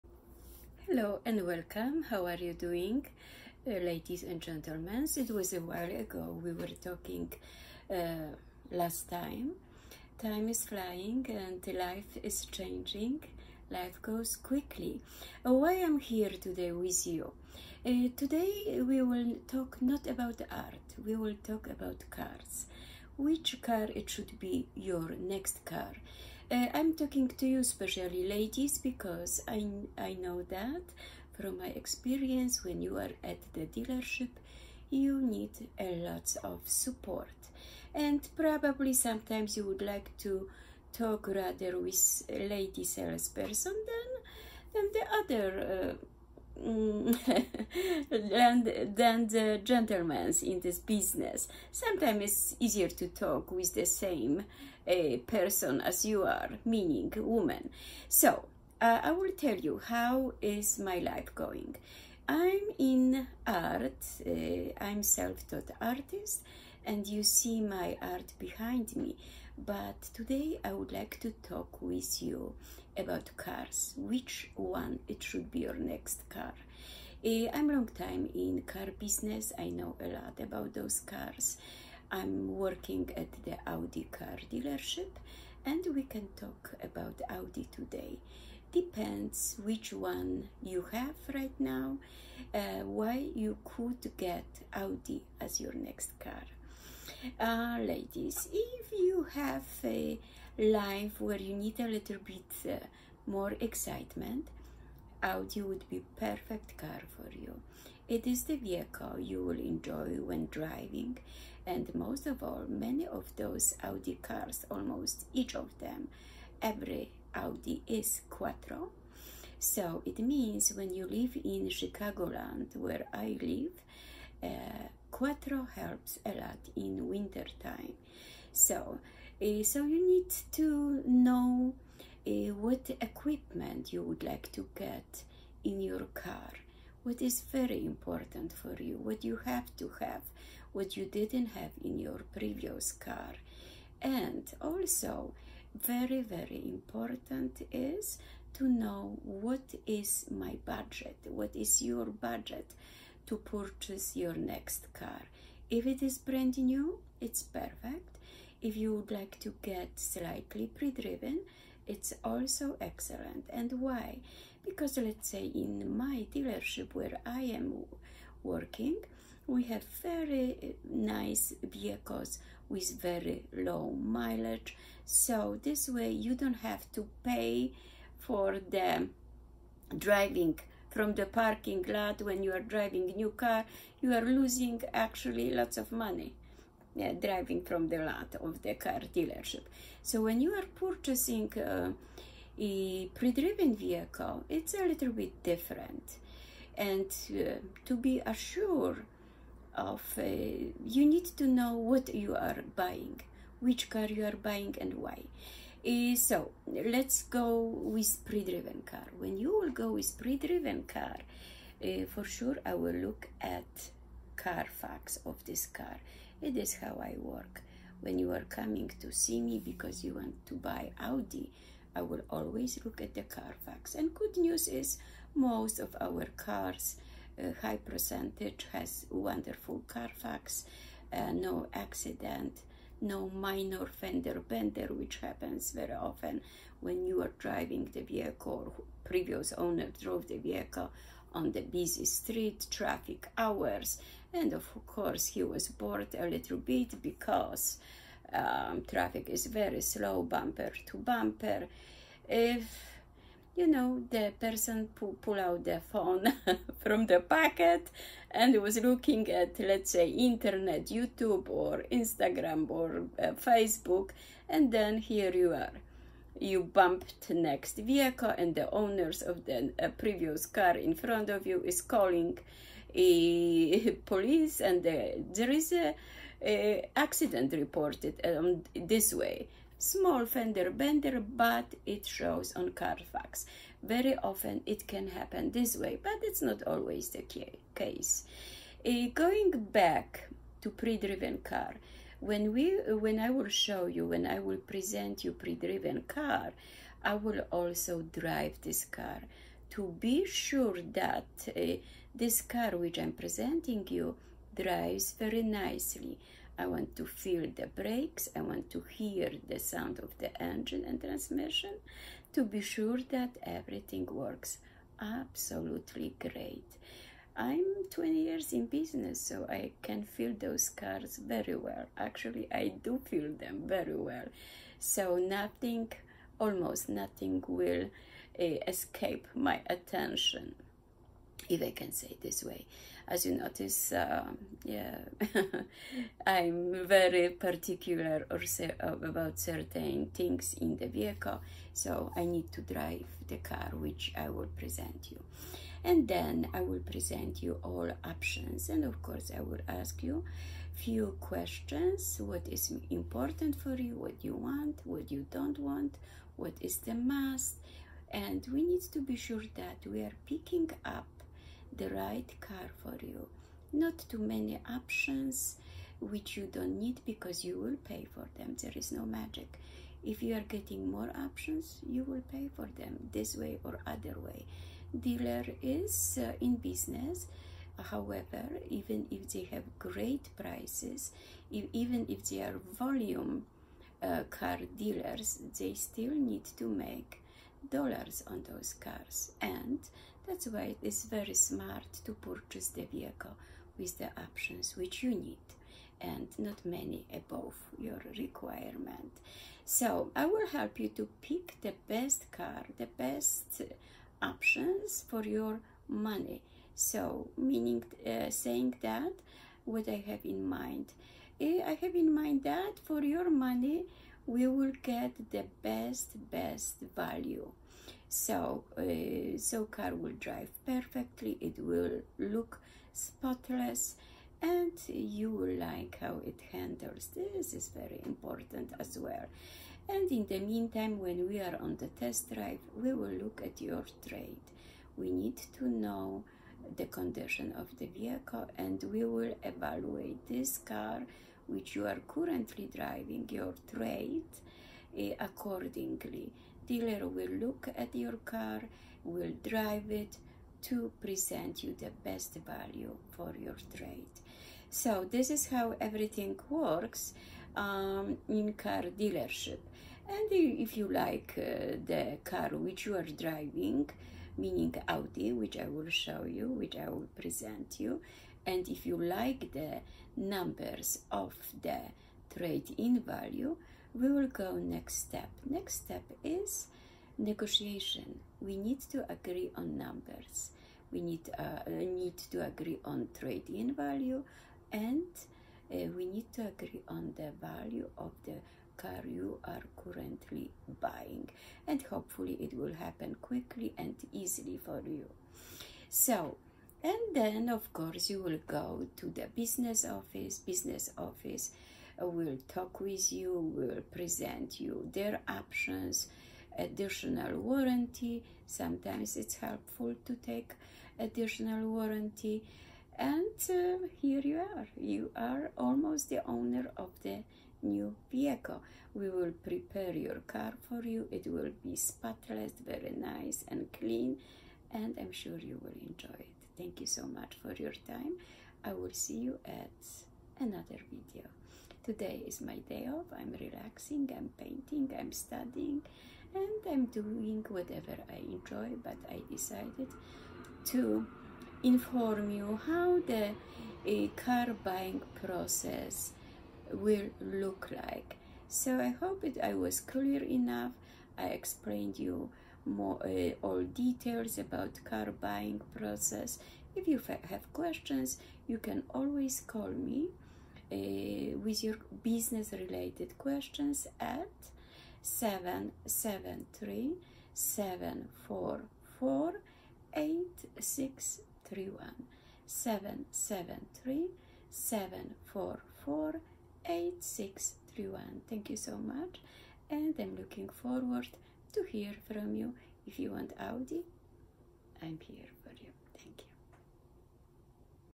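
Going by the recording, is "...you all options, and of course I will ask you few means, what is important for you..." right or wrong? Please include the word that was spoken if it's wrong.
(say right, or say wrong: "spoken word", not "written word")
wrong: "questions", not "means".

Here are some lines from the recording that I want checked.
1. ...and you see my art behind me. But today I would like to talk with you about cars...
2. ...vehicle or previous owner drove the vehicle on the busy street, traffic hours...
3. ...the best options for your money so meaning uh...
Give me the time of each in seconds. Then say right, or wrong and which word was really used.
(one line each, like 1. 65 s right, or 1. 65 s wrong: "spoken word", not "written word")
1. 66 s right
2. 238 s right
3. 402 s right.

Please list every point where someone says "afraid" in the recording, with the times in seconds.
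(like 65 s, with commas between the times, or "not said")
not said.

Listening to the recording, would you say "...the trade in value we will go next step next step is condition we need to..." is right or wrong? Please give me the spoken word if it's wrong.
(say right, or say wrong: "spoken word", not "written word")
wrong: "negotiation", not "condition".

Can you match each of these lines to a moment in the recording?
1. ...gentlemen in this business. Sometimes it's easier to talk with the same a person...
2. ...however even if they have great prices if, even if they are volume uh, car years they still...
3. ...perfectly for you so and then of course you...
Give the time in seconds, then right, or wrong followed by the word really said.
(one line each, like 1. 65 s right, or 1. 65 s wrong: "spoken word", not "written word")
1. 49 s right
2. 377 s wrong: "dealers", not "years"
3. 494 s wrong: "easily", not "perfectly".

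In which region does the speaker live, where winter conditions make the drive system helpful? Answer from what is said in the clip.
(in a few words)
Chicagoland.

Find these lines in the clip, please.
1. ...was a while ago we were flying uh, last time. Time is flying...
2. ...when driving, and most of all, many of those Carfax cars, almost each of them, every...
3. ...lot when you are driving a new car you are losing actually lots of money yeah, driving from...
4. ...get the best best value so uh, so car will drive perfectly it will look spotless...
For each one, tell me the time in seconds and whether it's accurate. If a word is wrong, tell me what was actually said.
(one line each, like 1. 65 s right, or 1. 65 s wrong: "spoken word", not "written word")
1. 5 s wrong: "talking", not "flying"
2. 110 s wrong: "Audi", not "Carfax"
3. 181 s right
4. 414 s right.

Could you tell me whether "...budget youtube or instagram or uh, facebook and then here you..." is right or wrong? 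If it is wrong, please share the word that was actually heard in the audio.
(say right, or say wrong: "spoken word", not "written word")
wrong: "internet", not "budget".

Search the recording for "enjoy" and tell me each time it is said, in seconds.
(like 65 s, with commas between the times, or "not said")
109 s, 525 s, 538 s.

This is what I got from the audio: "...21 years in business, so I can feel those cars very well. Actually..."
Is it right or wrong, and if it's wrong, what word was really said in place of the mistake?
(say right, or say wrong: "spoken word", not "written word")
wrong: "20", not "21".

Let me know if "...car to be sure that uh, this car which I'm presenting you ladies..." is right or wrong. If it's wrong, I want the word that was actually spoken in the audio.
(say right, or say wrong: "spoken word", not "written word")
wrong: "drives", not "ladies".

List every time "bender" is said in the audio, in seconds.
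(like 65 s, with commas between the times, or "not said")
234 s, 280 s.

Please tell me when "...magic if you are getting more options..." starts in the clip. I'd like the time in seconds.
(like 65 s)
369 s.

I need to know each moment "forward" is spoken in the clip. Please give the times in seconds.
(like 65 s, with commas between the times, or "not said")
580 s.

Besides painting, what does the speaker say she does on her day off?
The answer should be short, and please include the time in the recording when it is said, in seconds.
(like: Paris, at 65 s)
studying, at 534 s.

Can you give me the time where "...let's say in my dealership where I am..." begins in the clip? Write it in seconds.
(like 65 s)
164 s.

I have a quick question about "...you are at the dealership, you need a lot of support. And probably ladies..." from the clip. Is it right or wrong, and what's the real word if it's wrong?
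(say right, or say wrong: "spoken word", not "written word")
wrong: "sometimes", not "ladies".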